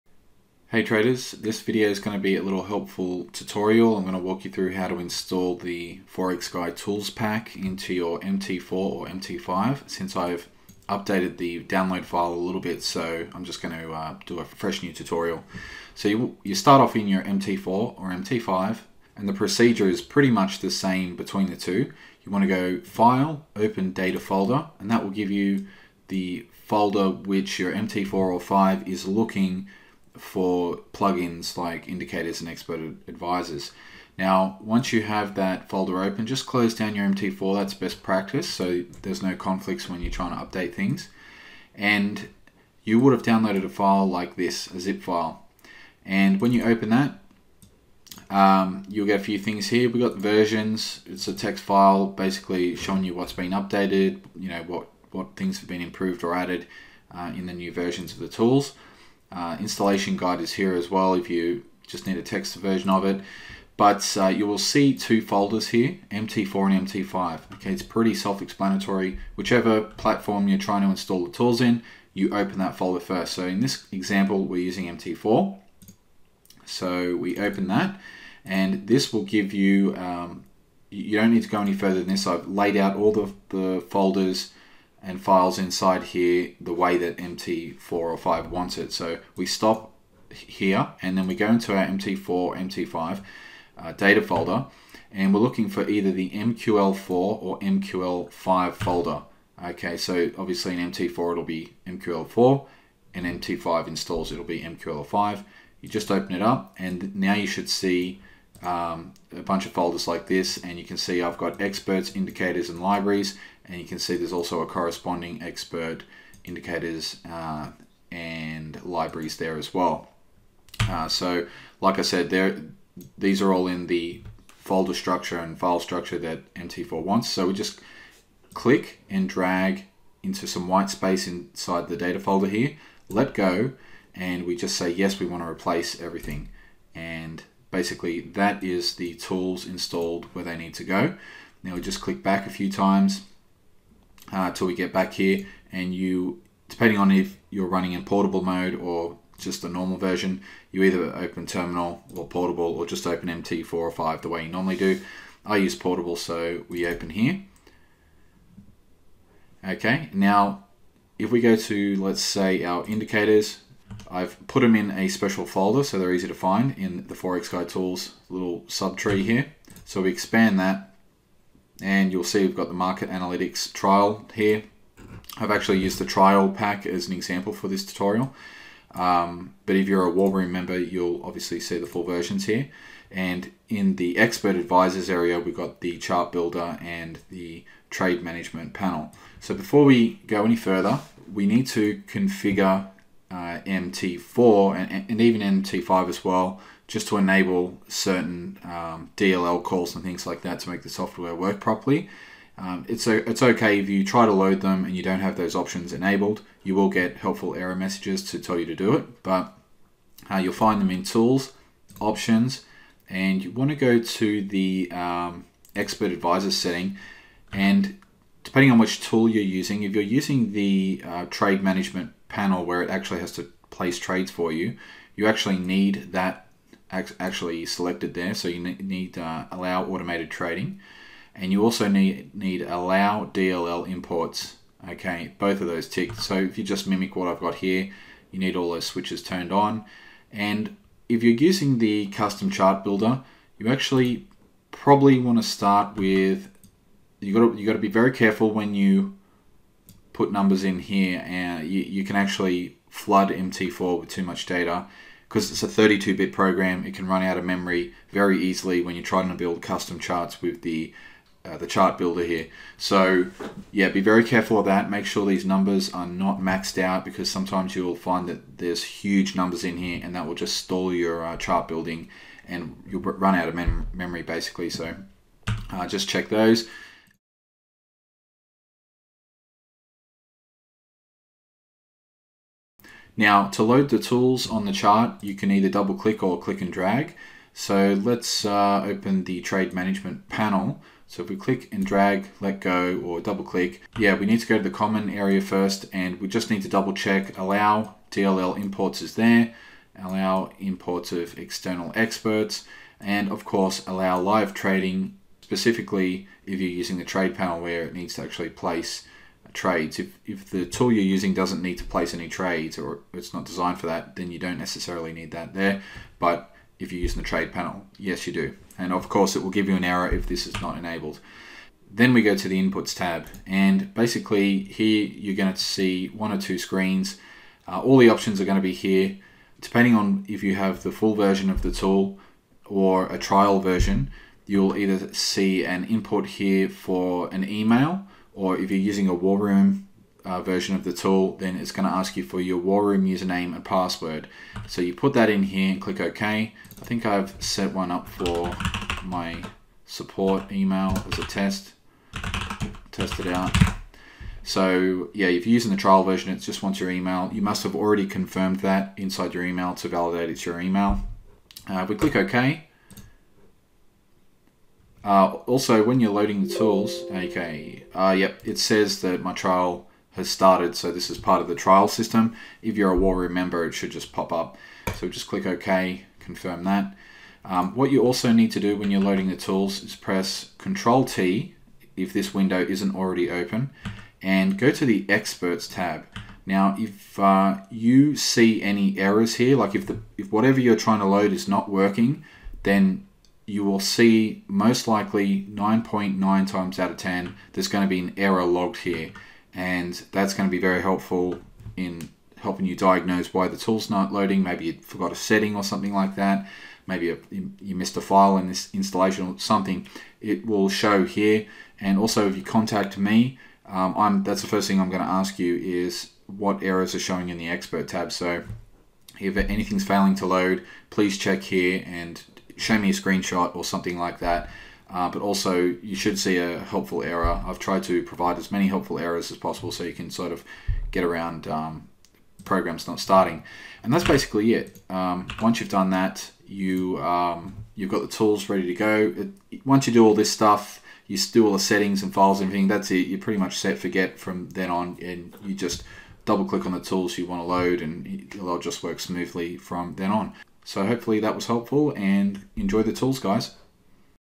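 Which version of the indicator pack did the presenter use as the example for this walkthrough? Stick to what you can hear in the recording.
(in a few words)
The trial pack.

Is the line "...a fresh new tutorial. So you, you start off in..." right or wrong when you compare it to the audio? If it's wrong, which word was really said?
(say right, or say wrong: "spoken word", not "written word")
right.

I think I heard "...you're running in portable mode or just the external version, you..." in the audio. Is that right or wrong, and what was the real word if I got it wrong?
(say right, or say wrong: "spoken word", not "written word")
wrong: "normal", not "external".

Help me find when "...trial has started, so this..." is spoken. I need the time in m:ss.
6:09.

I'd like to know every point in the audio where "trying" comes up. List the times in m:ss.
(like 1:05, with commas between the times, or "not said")
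0:40, 1:10, 4:19, 6:30.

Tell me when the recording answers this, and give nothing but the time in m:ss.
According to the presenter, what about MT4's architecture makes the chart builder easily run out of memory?
4:15.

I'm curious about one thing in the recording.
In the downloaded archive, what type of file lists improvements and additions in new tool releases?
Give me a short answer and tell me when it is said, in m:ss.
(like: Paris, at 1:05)
A text file, at 0:51.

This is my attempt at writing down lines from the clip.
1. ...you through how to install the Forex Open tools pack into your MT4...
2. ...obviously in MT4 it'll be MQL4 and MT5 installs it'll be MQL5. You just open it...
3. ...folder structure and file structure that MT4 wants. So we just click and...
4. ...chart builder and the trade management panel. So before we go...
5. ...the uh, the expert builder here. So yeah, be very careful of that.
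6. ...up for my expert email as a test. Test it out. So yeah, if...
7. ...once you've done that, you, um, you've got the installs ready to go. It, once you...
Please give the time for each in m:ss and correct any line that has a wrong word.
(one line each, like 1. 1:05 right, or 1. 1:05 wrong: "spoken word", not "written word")
1. 0:04 wrong: "Guy", not "Open"
2. 1:40 right
3. 2:04 right
4. 3:05 right
5. 4:20 wrong: "chart", not "expert"
6. 5:47 wrong: "support", not "expert"
7. 7:15 wrong: "tools", not "installs".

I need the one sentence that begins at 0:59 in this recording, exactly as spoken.
Uh, installation guide is here as well if you just need a text version of it.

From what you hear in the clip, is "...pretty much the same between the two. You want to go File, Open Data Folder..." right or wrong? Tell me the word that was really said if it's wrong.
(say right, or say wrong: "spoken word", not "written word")
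right.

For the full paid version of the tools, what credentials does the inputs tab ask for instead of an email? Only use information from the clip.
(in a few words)
War Room username and password.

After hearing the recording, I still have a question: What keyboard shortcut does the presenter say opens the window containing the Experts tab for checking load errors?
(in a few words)
Control T.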